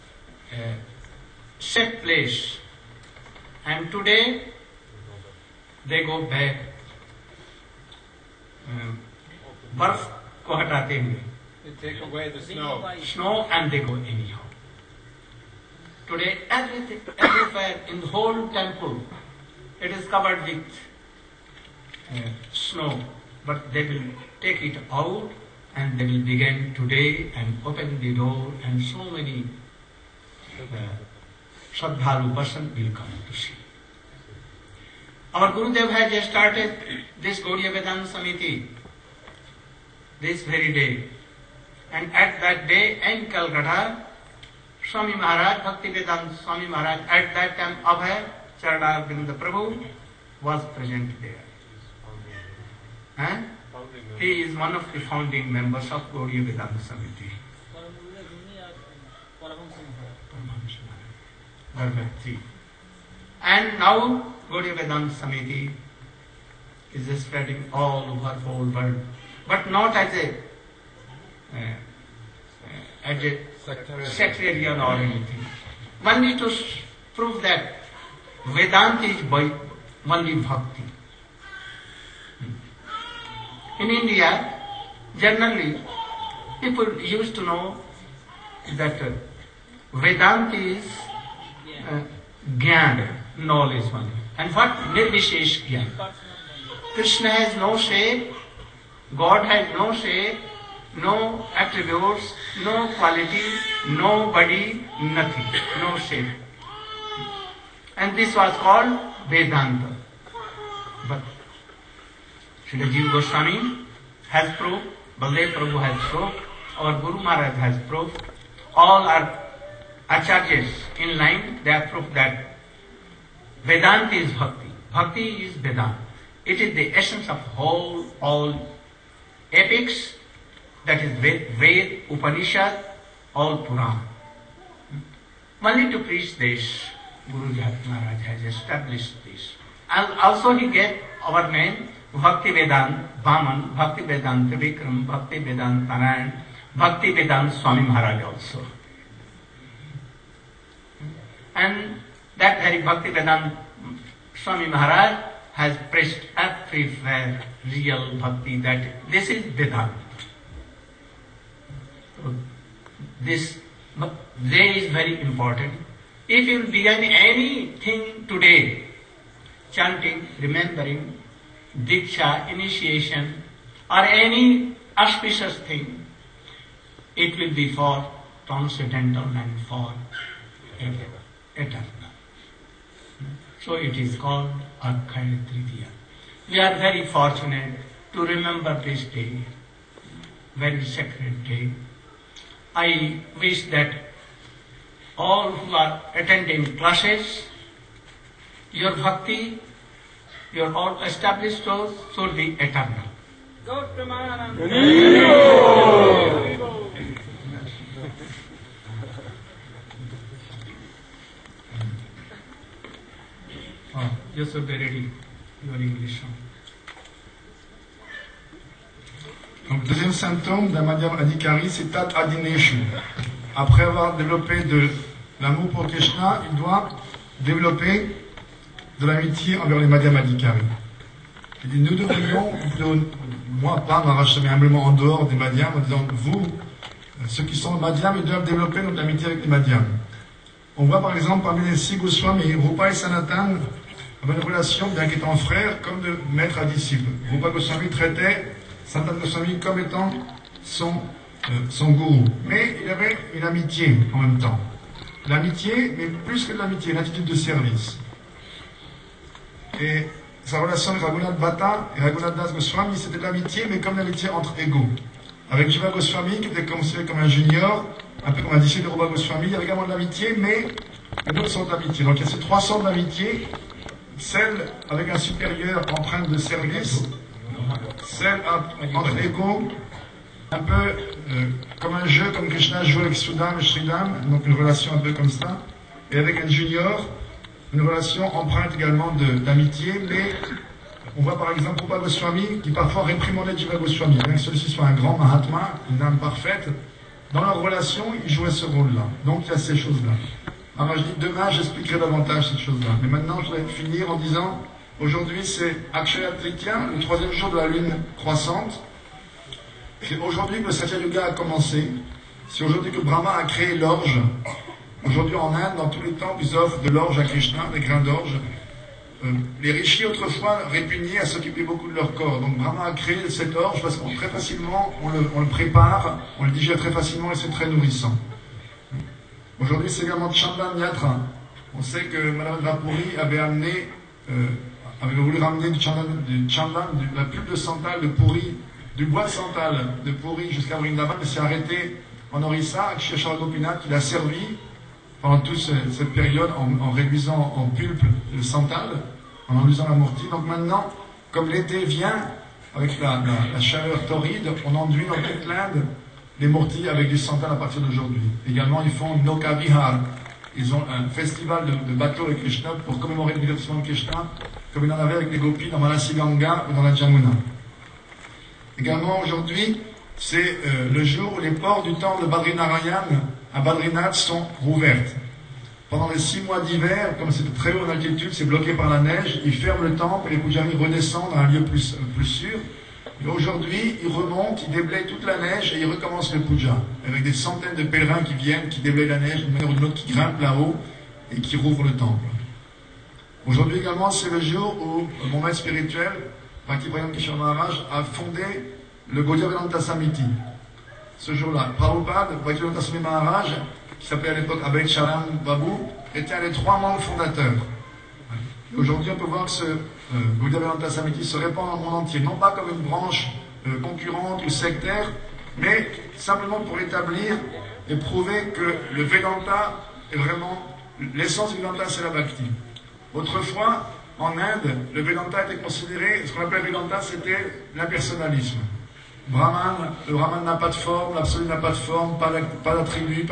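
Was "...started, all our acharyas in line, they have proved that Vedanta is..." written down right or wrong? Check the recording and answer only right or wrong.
wrong.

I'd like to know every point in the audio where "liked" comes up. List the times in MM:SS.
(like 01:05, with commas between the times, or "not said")
not said.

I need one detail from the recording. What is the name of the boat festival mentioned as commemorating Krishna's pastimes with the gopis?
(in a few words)
Nokavihar.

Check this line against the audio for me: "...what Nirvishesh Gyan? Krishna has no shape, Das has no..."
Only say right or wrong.
wrong.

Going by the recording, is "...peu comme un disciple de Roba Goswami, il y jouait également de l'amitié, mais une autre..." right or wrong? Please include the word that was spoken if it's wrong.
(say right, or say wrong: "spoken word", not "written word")
wrong: "avait", not "jouait".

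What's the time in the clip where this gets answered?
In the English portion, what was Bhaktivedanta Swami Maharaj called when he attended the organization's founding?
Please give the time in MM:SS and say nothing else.
00:47.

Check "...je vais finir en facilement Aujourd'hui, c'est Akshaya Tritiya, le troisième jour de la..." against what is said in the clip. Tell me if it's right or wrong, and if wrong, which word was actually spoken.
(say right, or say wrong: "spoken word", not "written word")
wrong: "disant", not "facilement".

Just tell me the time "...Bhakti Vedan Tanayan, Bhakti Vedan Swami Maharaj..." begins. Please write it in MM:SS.
02:25.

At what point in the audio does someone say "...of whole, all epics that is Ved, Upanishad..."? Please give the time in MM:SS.
02:07.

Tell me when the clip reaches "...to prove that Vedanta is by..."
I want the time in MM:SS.
01:16.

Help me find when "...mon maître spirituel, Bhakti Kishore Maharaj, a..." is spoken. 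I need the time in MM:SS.
06:35.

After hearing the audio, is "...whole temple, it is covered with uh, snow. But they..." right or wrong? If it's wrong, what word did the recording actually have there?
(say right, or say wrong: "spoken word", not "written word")
right.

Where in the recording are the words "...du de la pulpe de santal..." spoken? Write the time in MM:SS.
05:36.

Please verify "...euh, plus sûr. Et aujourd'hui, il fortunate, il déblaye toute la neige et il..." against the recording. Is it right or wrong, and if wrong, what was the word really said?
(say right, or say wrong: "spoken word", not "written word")
wrong: "remonte", not "fortunate".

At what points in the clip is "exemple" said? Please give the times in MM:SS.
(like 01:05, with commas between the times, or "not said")
04:01, 04:51.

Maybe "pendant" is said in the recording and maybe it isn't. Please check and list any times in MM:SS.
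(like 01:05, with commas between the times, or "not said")
05:45, 06:15.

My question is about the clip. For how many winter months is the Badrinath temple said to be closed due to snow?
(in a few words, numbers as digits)
6.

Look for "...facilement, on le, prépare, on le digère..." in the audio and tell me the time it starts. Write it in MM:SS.
05:24.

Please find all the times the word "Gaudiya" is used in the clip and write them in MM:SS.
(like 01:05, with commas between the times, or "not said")
00:37, 00:56, 01:04, 06:39.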